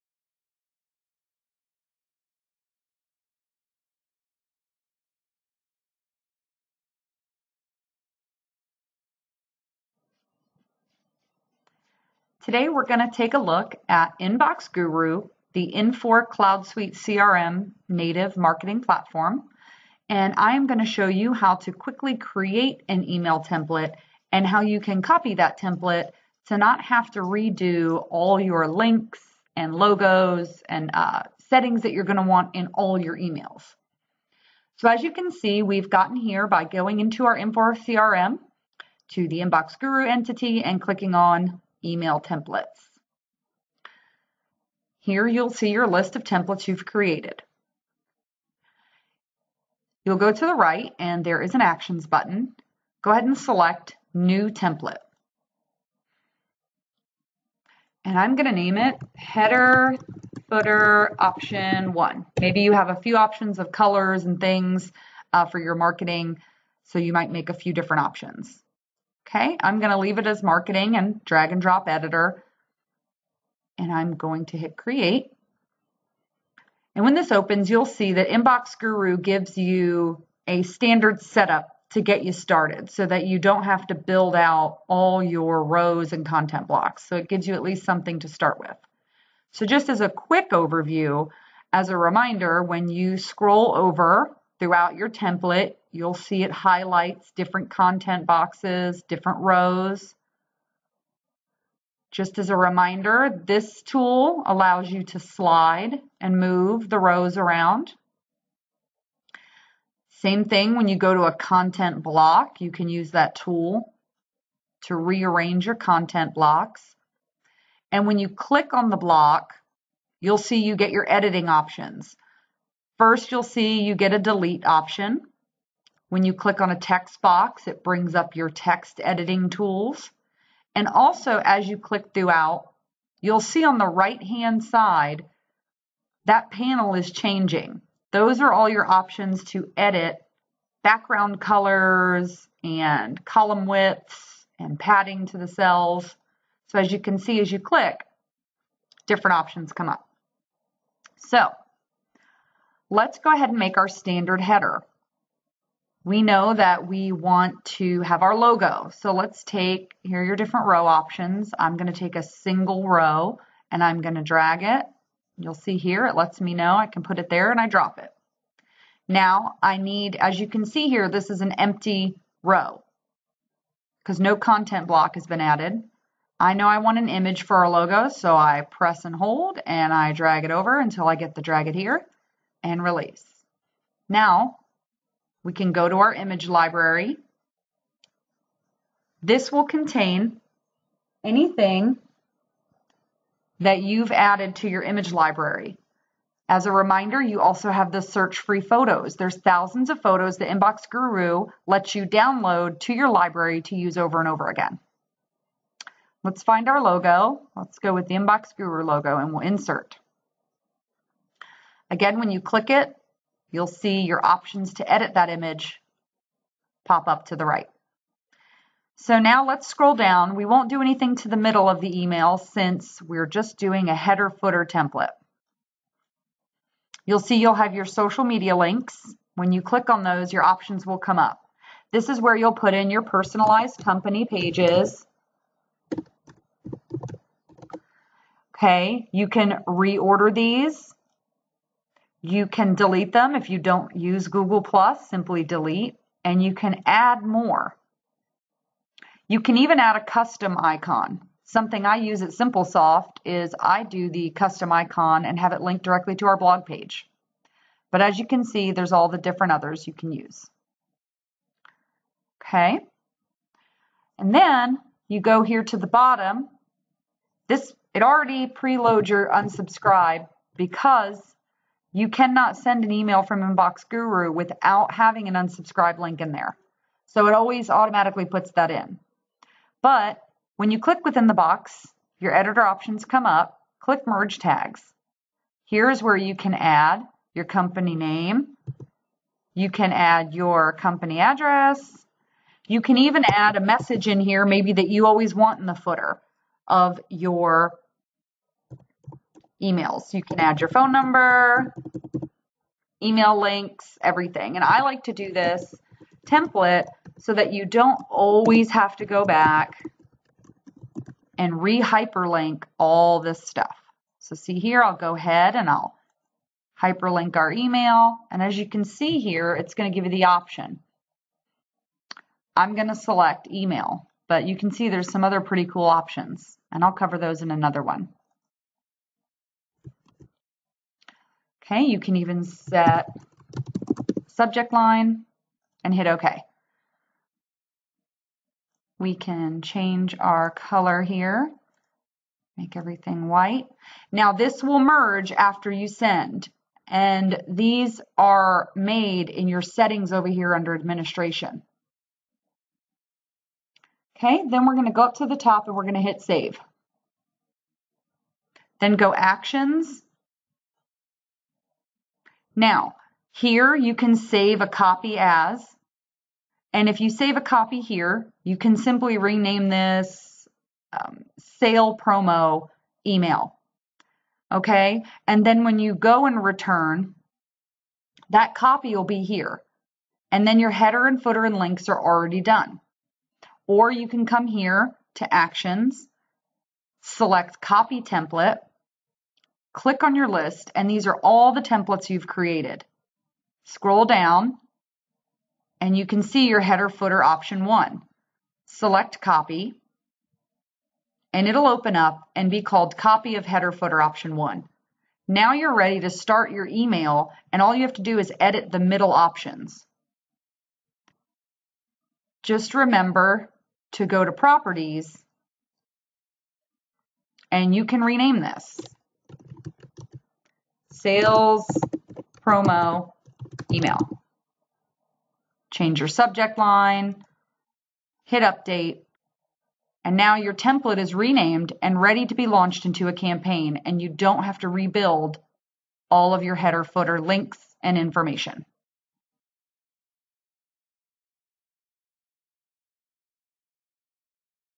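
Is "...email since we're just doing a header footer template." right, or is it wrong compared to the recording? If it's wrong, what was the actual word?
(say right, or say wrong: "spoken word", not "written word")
right.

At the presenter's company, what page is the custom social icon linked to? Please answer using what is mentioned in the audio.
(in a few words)
blog page.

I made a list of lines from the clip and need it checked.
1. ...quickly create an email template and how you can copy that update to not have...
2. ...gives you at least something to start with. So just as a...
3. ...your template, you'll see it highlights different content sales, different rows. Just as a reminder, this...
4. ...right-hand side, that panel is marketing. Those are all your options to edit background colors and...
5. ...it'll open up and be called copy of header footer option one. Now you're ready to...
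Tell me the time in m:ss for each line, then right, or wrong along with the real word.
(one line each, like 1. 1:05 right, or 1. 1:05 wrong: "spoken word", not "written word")
1. 0:21 wrong: "template", not "update"
2. 1:27 right
3. 1:34 wrong: "boxes", not "sales"
4. 2:13 wrong: "changing", not "marketing"
5. 6:41 right.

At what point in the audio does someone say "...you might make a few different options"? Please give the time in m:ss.
1:06.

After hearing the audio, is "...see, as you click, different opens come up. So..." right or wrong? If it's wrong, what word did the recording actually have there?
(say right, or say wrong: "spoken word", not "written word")
wrong: "options", not "opens".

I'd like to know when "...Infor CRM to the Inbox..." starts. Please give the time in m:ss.
0:37.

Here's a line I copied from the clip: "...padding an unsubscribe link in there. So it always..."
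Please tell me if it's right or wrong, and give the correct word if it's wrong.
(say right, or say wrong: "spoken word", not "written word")
wrong: "having", not "padding".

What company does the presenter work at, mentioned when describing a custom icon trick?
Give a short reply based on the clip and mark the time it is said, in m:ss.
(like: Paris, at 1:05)
SimpleSoft, at 4:12.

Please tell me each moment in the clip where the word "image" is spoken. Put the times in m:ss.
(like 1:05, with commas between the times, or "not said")
2:57, 3:06, 3:14, 3:35.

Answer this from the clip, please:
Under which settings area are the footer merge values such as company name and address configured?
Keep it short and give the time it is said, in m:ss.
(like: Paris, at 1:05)
administration, at 5:50.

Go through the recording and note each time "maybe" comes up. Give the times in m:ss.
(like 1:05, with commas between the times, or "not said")
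1:02, 4:54.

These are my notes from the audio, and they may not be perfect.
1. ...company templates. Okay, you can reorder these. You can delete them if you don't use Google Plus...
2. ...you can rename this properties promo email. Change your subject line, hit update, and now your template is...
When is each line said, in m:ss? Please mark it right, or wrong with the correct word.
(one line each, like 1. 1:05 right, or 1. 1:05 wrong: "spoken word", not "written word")
1. 3:53 wrong: "pages", not "templates"
2. 6:57 wrong: "sales", not "properties".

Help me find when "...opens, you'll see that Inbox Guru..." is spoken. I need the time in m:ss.
1:17.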